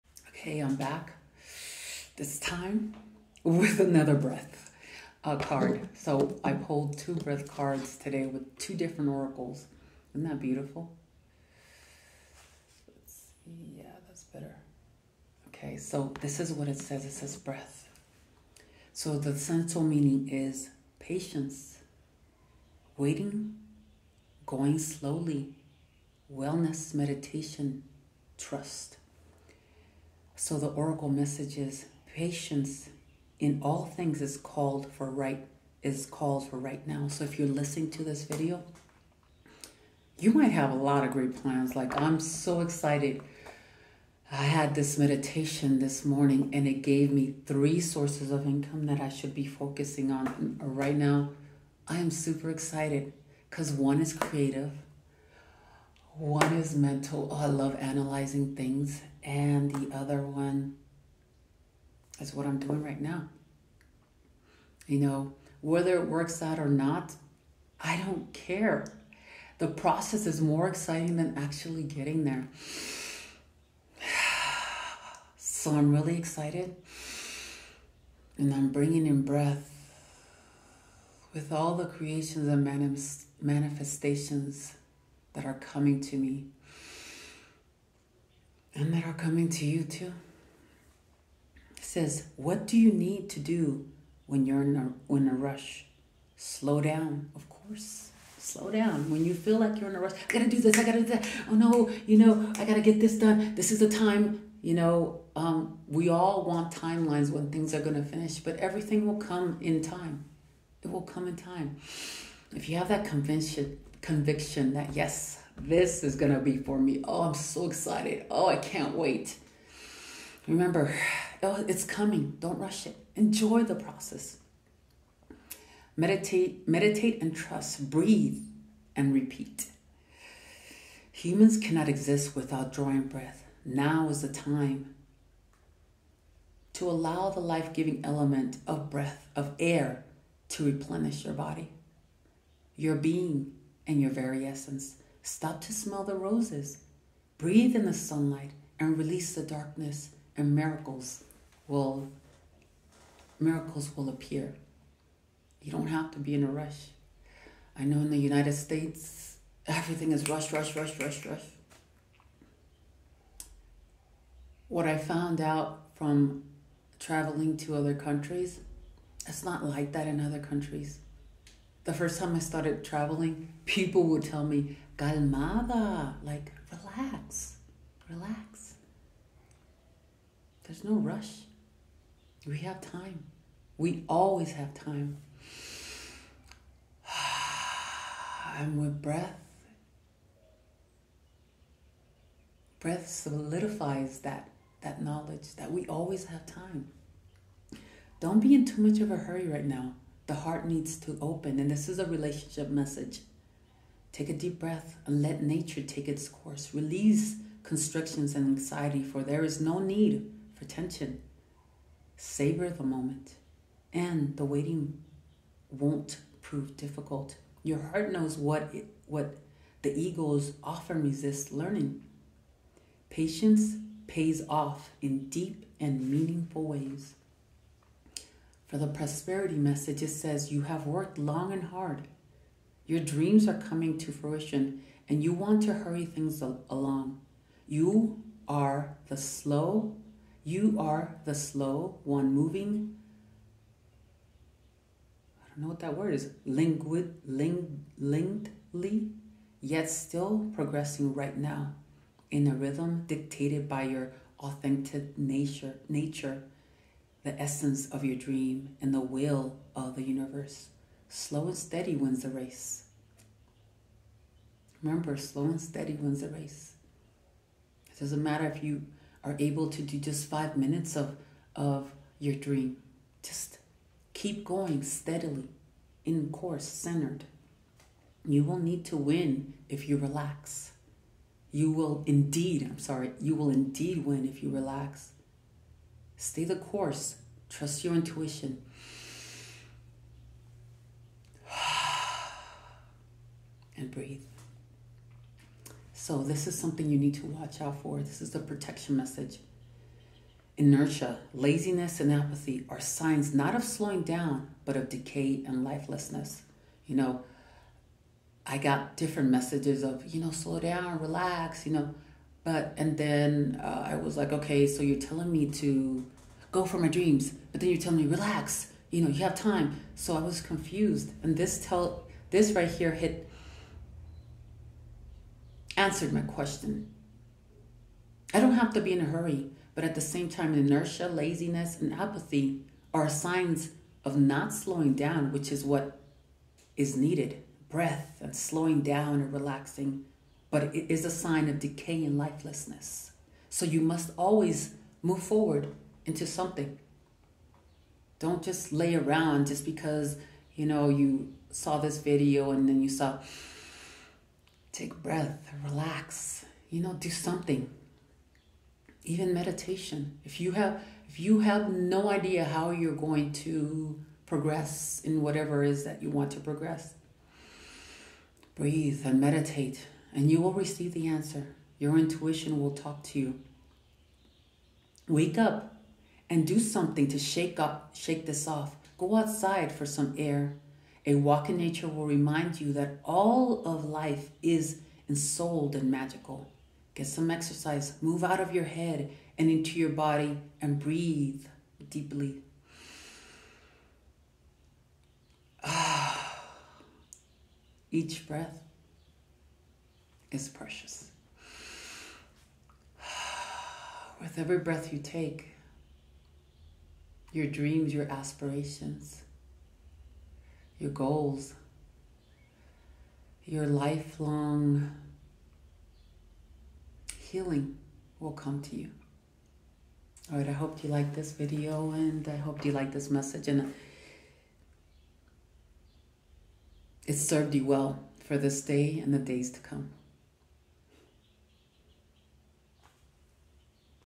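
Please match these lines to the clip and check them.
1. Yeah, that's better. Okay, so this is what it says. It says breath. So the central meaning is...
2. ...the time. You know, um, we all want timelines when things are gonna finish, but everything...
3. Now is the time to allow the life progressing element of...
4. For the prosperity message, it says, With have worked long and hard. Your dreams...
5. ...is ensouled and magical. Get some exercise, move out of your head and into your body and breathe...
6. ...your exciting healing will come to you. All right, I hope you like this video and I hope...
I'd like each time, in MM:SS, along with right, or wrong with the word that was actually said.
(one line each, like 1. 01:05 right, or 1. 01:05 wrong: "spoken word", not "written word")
1. 00:13 right
2. 01:43 right
3. 02:13 wrong: "giving", not "progressing"
4. 03:48 wrong: "You", not "With"
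5. 06:24 right
6. 06:53 wrong: "lifelong", not "exciting".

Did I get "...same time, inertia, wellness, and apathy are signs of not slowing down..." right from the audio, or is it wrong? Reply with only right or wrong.
wrong.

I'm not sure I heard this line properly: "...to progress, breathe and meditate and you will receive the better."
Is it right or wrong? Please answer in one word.
wrong.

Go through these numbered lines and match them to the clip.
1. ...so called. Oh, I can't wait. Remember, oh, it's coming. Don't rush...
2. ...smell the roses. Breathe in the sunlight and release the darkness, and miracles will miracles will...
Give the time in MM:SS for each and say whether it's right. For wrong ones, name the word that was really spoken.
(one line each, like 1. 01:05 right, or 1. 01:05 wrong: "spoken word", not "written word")
1. 01:57 wrong: "excited", not "called"
2. 02:25 right.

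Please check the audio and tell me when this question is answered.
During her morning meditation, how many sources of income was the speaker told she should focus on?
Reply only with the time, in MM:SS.
00:47.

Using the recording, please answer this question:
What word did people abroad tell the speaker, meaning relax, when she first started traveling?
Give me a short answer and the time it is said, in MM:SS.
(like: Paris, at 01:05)
calmada, at 02:54.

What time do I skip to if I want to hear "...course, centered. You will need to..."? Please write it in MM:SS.
04:36.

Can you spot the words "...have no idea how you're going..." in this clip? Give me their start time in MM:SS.
06:01.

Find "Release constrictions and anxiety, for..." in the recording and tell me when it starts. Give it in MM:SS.
03:26.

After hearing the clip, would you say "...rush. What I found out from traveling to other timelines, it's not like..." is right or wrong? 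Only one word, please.
wrong.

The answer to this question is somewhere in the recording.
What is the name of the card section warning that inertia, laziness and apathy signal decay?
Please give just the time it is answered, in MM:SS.
04:58.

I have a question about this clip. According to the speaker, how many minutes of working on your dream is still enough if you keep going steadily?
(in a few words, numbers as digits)
5.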